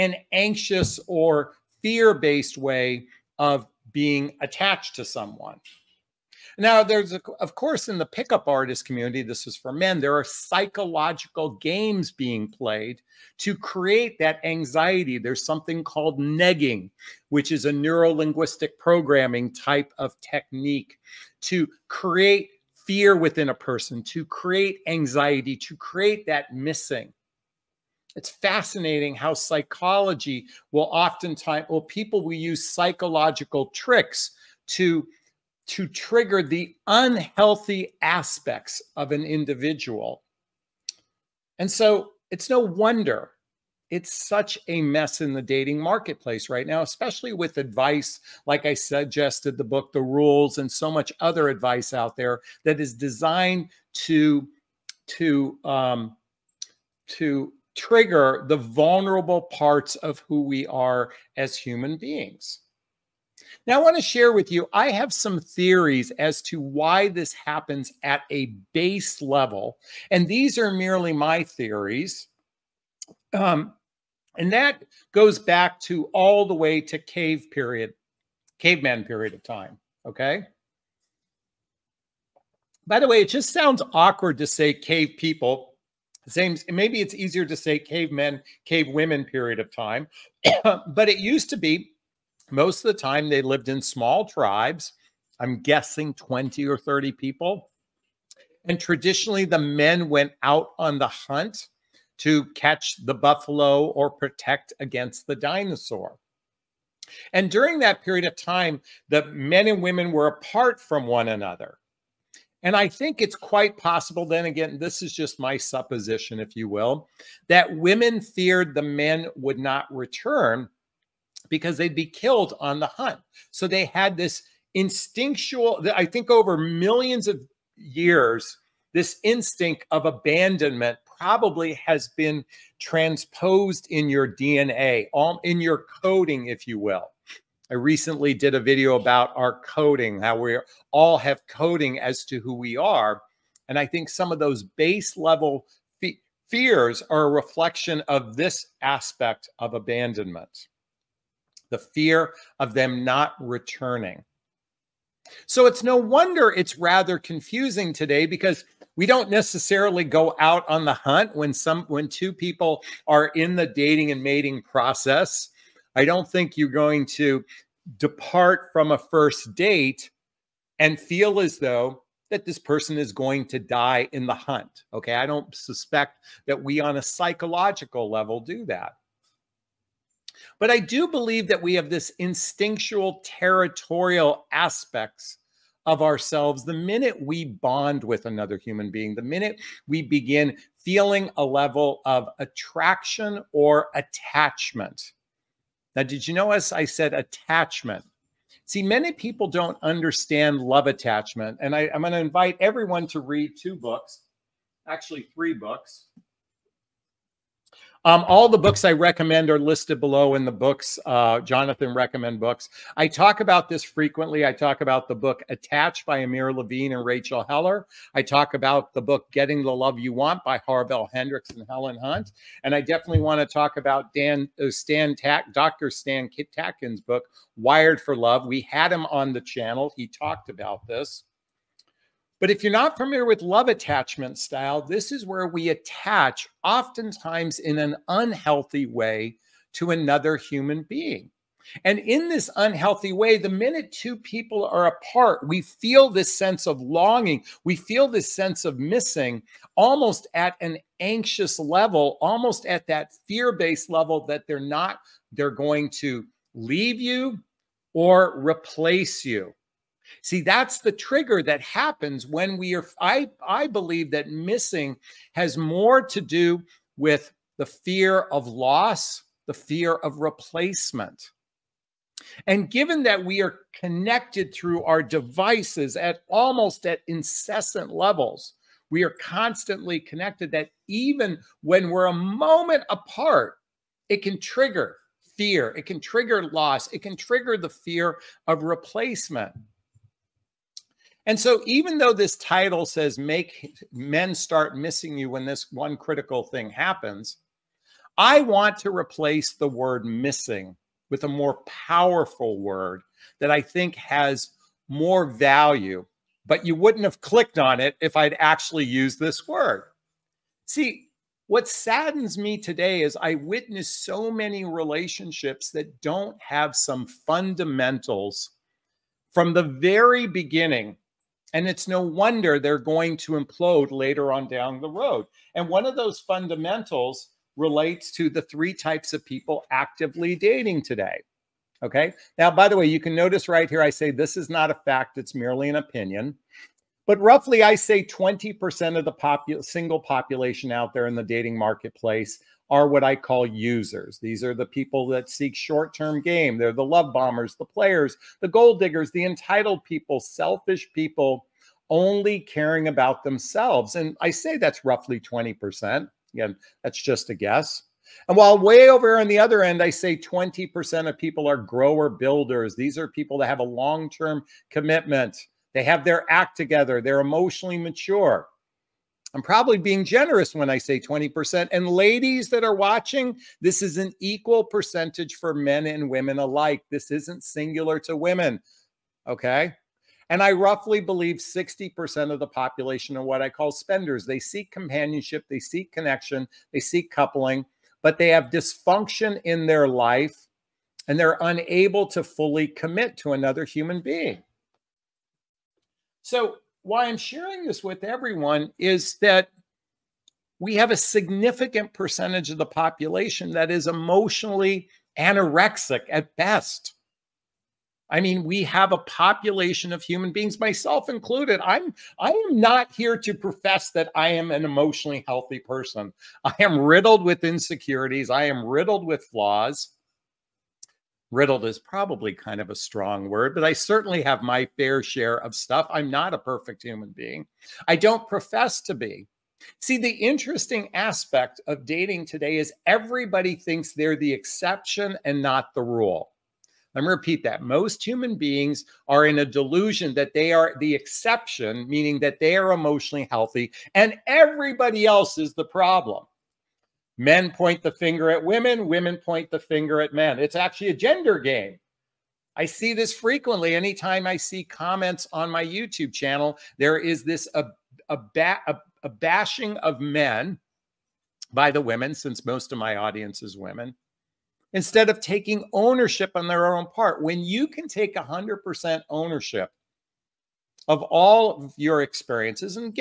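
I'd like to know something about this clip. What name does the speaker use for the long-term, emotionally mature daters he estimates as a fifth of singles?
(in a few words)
Grower builders.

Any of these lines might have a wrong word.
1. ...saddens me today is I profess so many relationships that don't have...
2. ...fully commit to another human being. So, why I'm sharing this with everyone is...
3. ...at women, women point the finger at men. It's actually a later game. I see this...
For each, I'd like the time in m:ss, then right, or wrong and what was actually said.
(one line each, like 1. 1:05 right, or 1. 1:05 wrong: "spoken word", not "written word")
1. 5:11 wrong: "witness", not "profess"
2. 6:32 right
3. 7:28 wrong: "gender", not "later".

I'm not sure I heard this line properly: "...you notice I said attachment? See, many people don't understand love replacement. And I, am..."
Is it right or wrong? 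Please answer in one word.
wrong.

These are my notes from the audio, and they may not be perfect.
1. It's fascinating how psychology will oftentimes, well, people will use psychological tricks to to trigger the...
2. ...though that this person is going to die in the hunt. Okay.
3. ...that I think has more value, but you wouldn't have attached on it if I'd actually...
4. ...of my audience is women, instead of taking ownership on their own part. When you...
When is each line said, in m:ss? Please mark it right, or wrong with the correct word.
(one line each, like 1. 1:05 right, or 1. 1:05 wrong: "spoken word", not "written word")
1. 0:28 right
2. 2:51 right
3. 5:03 wrong: "clicked", not "attached"
4. 7:42 right.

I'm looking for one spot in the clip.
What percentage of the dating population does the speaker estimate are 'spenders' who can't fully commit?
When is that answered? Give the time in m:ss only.
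6:21.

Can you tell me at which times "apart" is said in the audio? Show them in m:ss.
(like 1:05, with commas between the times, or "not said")
1:50, 4:04, 4:42.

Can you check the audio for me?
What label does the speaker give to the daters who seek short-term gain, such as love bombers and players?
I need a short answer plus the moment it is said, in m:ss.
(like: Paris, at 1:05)
Users, at 5:43.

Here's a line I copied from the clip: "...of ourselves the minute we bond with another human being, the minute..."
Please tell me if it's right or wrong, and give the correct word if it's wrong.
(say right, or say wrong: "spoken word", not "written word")
right.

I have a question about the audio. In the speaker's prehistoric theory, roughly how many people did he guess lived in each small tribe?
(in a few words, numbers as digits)
20 or 30.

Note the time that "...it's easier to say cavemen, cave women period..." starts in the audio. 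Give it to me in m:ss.
1:26.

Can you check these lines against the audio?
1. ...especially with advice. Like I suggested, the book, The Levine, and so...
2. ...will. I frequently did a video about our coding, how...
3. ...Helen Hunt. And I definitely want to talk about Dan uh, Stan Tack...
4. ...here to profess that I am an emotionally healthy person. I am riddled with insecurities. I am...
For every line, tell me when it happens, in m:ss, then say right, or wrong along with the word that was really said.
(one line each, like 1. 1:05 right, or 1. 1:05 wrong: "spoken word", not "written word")
1. 0:46 wrong: "Rules", not "Levine"
2. 2:16 wrong: "recently", not "frequently"
3. 3:41 right
4. 6:52 right.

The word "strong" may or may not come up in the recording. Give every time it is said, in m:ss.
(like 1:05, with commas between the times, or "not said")
7:02.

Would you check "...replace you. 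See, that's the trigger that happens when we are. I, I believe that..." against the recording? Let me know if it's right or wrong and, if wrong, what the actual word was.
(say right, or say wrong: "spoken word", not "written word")
right.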